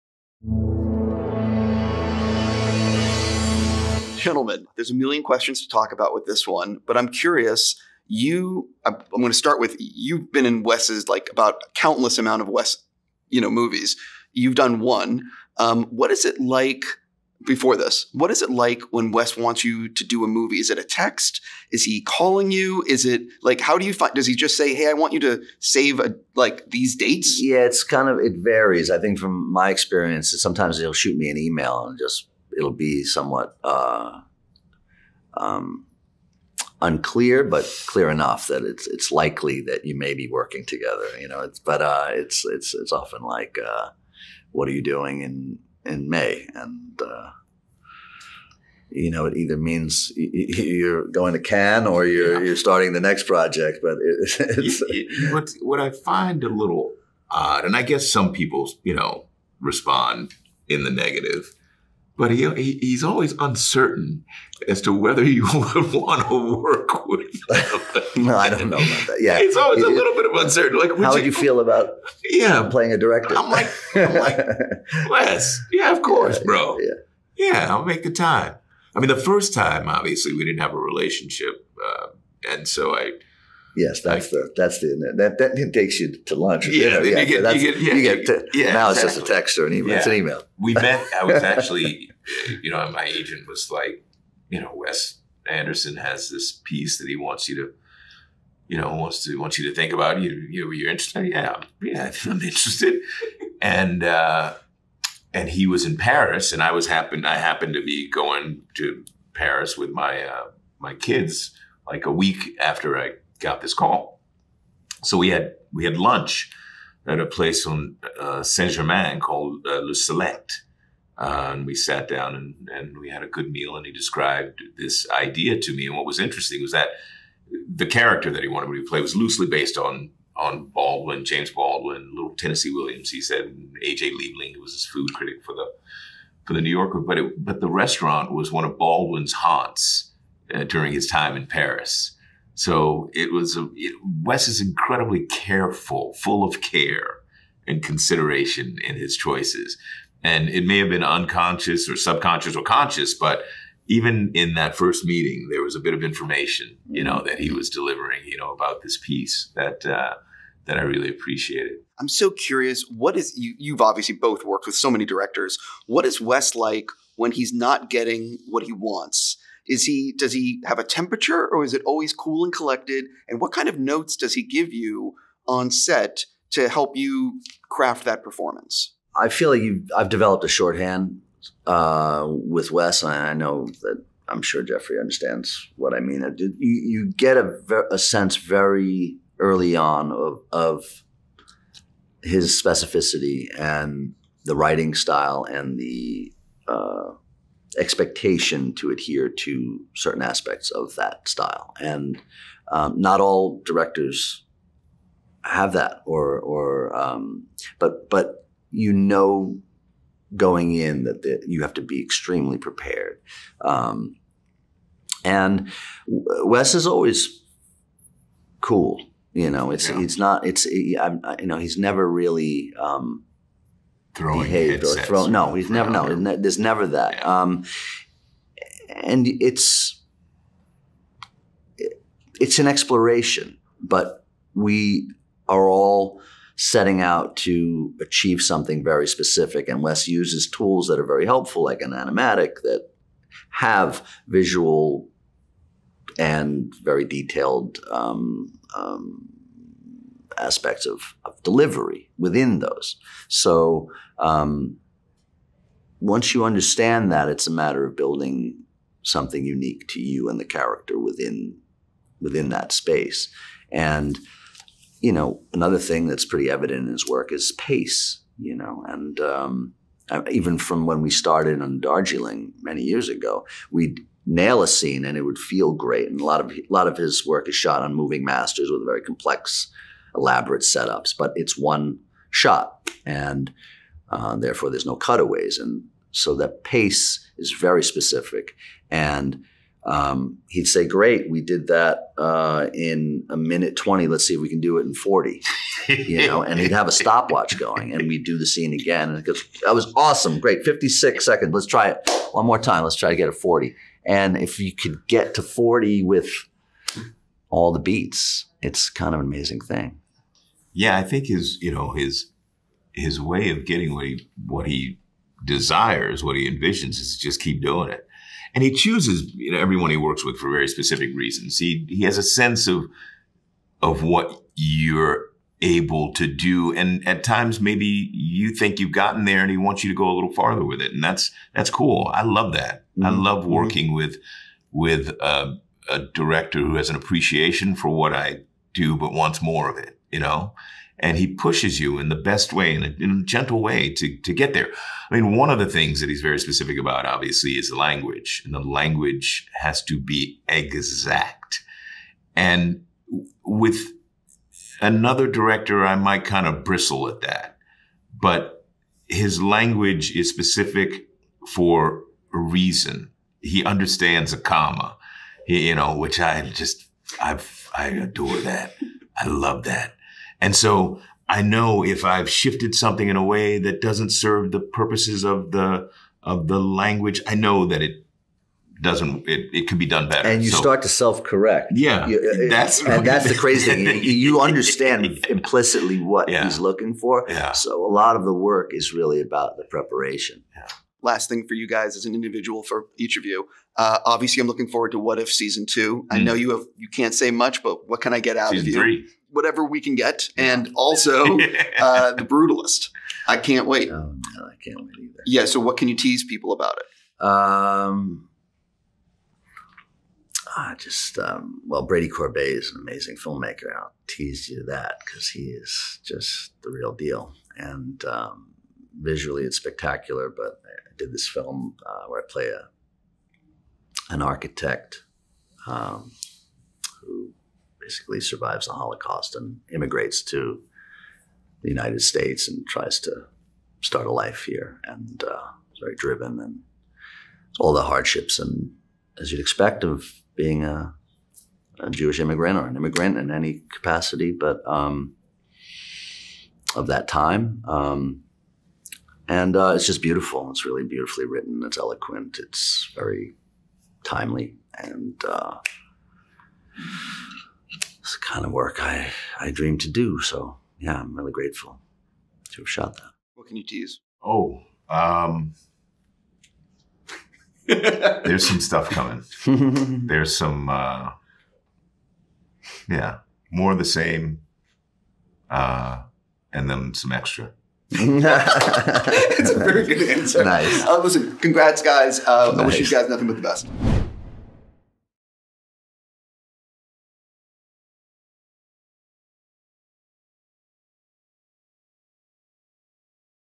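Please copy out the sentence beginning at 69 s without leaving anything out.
Yeah, it's always it, a little bit of uncertain.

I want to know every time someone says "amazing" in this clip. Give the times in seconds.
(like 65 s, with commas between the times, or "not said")
309 s, 412 s.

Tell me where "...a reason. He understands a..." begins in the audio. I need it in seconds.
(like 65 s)
362 s.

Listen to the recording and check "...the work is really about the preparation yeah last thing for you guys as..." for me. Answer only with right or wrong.
right.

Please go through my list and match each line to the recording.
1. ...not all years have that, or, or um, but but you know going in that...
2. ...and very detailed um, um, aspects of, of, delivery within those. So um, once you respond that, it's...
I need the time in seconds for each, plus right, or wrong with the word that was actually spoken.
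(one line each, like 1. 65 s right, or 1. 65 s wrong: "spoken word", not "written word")
1. 203 s wrong: "directors", not "years"
2. 246 s wrong: "understand", not "respond".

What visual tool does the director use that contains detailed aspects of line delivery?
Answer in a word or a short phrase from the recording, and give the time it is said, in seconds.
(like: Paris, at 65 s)
An animatic, at 241 s.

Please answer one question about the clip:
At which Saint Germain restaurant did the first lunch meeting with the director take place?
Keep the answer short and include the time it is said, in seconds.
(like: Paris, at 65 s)
Le Select, at 119 s.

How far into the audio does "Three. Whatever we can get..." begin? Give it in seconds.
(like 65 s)
398 s.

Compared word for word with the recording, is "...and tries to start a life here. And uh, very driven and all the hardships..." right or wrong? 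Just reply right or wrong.
right.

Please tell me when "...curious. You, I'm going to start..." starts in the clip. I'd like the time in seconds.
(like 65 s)
7 s.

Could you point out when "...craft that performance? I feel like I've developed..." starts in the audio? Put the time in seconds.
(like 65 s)
177 s.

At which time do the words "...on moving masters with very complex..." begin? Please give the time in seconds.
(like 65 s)
277 s.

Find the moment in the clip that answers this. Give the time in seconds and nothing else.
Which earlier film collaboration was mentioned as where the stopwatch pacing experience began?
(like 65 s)
271 s.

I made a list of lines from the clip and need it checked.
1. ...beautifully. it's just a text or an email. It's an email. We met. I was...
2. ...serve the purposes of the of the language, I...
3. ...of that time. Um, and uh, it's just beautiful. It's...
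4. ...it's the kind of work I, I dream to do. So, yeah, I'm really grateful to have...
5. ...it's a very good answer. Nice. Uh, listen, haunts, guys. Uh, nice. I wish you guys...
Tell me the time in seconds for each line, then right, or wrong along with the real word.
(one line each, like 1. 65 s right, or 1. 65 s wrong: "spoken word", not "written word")
1. 88 s wrong: "exactly", not "beautifully"
2. 374 s right
3. 446 s right
4. 457 s right
5. 477 s wrong: "congrats", not "haunts".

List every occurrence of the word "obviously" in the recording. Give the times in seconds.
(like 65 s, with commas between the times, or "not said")
79 s, 163 s, 347 s, 394 s.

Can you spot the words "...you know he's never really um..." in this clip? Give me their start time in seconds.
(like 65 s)
221 s.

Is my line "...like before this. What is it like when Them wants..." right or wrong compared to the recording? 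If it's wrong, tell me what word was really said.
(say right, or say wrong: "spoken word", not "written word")
wrong: "Wes", not "Them".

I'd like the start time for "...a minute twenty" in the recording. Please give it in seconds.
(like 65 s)
293 s.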